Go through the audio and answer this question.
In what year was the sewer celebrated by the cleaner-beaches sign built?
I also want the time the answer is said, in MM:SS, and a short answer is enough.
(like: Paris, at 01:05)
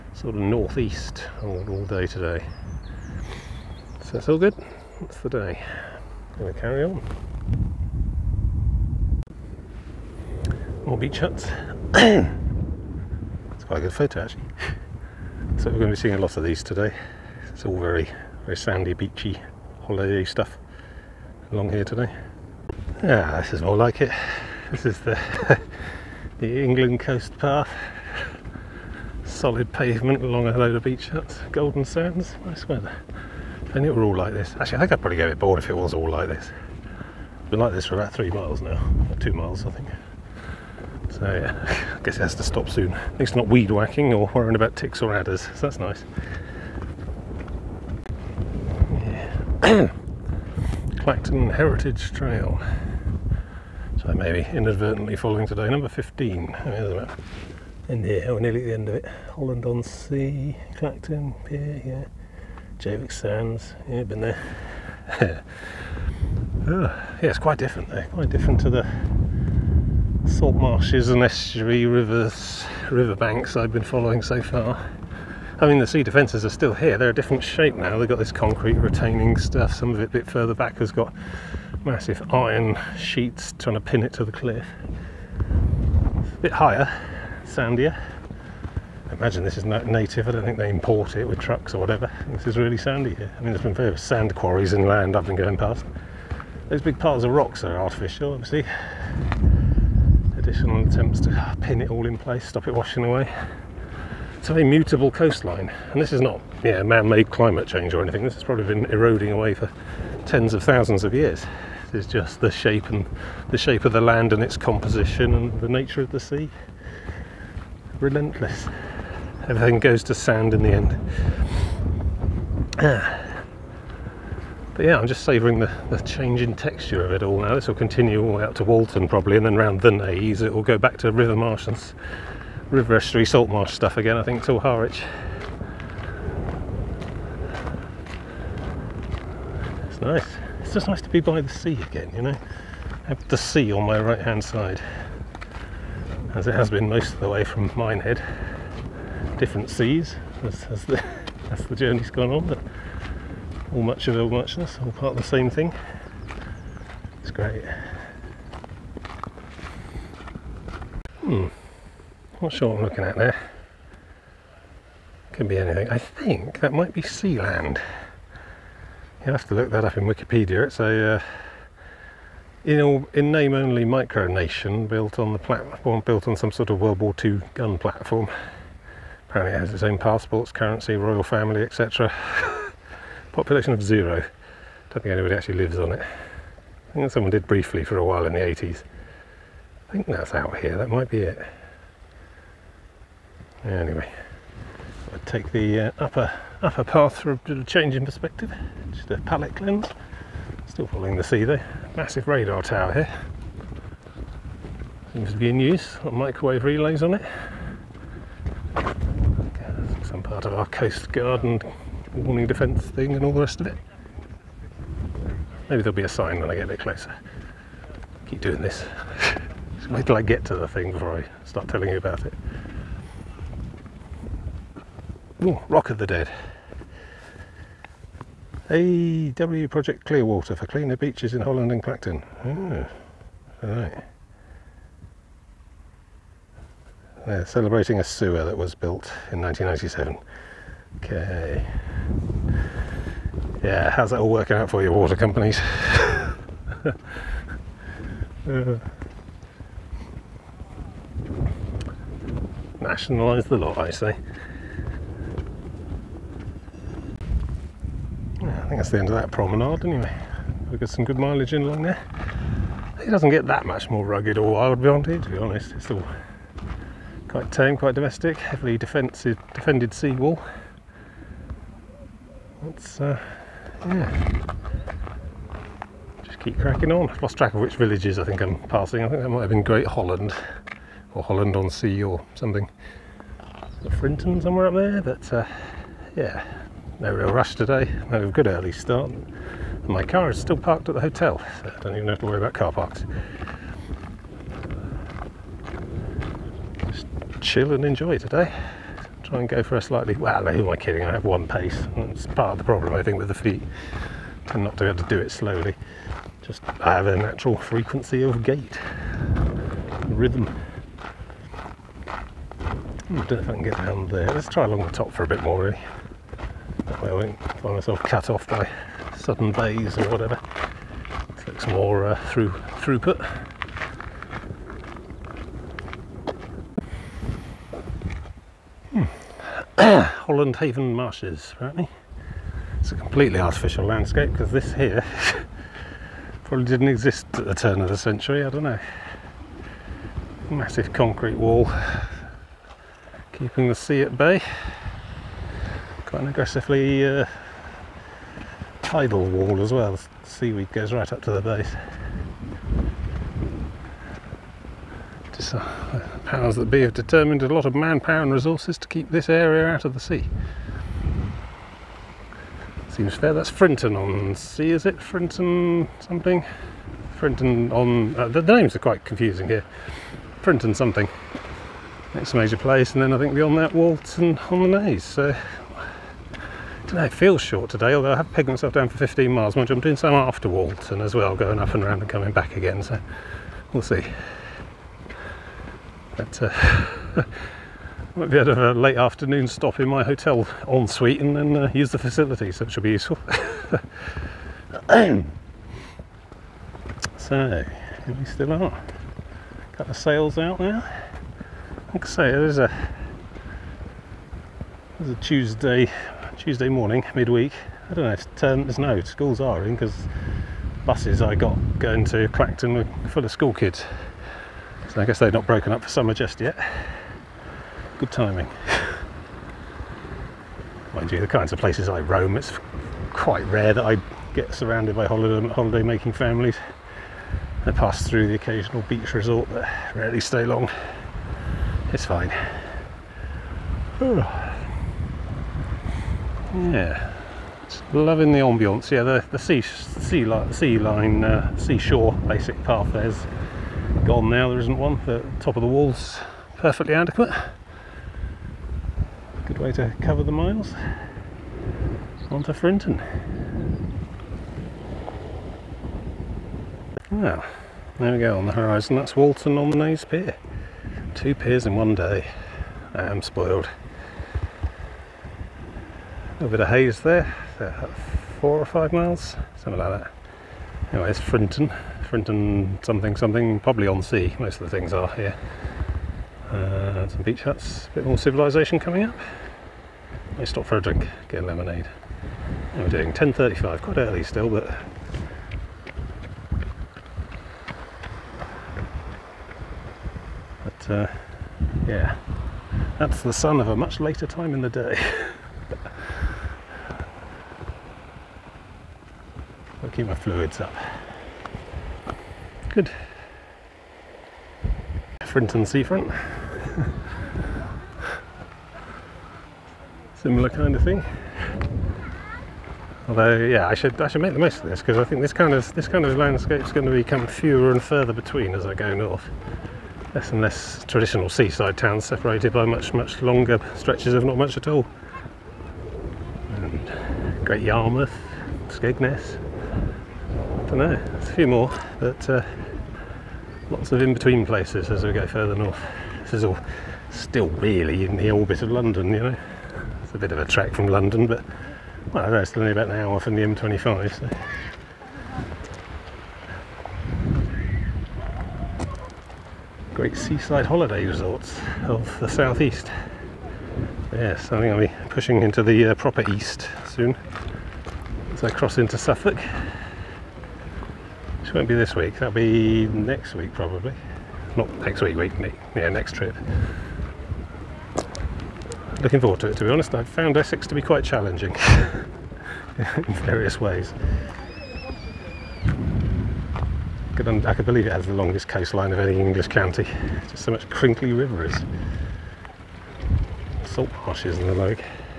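1997, at 03:59.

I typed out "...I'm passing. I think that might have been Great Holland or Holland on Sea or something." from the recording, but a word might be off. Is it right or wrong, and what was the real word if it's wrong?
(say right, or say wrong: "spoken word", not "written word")
right.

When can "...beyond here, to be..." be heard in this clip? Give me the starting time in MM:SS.
04:24.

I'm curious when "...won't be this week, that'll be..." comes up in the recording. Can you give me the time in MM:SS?
09:21.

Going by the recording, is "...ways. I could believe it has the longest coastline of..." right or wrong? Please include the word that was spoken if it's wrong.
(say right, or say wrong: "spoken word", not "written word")
right.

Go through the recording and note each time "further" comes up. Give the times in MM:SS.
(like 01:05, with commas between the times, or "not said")
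01:20, 08:37, 08:55.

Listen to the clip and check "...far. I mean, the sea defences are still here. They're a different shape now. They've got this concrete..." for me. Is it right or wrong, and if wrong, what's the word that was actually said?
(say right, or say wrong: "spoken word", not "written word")
right.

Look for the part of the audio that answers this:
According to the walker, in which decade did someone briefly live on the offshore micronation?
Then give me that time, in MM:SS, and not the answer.
03:08.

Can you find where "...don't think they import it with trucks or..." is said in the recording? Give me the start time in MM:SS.
01:30.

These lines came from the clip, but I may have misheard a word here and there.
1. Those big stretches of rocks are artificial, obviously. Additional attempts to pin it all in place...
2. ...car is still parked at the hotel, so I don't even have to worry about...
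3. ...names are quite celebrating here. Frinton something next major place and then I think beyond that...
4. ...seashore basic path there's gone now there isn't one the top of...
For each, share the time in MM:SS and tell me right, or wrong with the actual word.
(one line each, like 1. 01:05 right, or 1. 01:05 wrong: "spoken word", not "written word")
1. 01:36 wrong: "piles", not "stretches"
2. 04:50 right
3. 06:08 wrong: "confusing", not "celebrating"
4. 07:21 right.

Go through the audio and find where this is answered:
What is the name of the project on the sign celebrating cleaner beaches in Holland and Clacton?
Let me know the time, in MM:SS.
03:49.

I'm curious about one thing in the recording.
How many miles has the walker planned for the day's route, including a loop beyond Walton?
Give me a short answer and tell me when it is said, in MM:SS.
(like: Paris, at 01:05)
15, at 06:18.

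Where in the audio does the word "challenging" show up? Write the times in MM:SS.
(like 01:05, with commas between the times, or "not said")
09:31.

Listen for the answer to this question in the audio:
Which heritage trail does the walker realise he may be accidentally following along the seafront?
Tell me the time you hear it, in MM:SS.
00:50.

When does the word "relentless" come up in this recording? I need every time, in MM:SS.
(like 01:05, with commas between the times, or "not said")
01:58.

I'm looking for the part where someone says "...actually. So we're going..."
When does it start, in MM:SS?
00:14.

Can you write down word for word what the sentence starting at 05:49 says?
The seaweed goes right up to the base.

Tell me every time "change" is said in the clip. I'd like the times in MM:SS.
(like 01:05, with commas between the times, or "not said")
01:47, 02:05, 03:17.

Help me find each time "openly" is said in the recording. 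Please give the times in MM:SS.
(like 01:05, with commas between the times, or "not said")
not said.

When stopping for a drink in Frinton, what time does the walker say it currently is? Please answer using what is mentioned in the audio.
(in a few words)
10.35.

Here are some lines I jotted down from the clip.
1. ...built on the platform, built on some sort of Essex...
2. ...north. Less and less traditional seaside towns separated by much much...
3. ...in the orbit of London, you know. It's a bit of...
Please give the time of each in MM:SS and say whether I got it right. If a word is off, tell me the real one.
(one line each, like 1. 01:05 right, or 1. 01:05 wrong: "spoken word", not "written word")
1. 02:54 wrong: "World", not "Essex"
2. 08:38 right
3. 08:58 right.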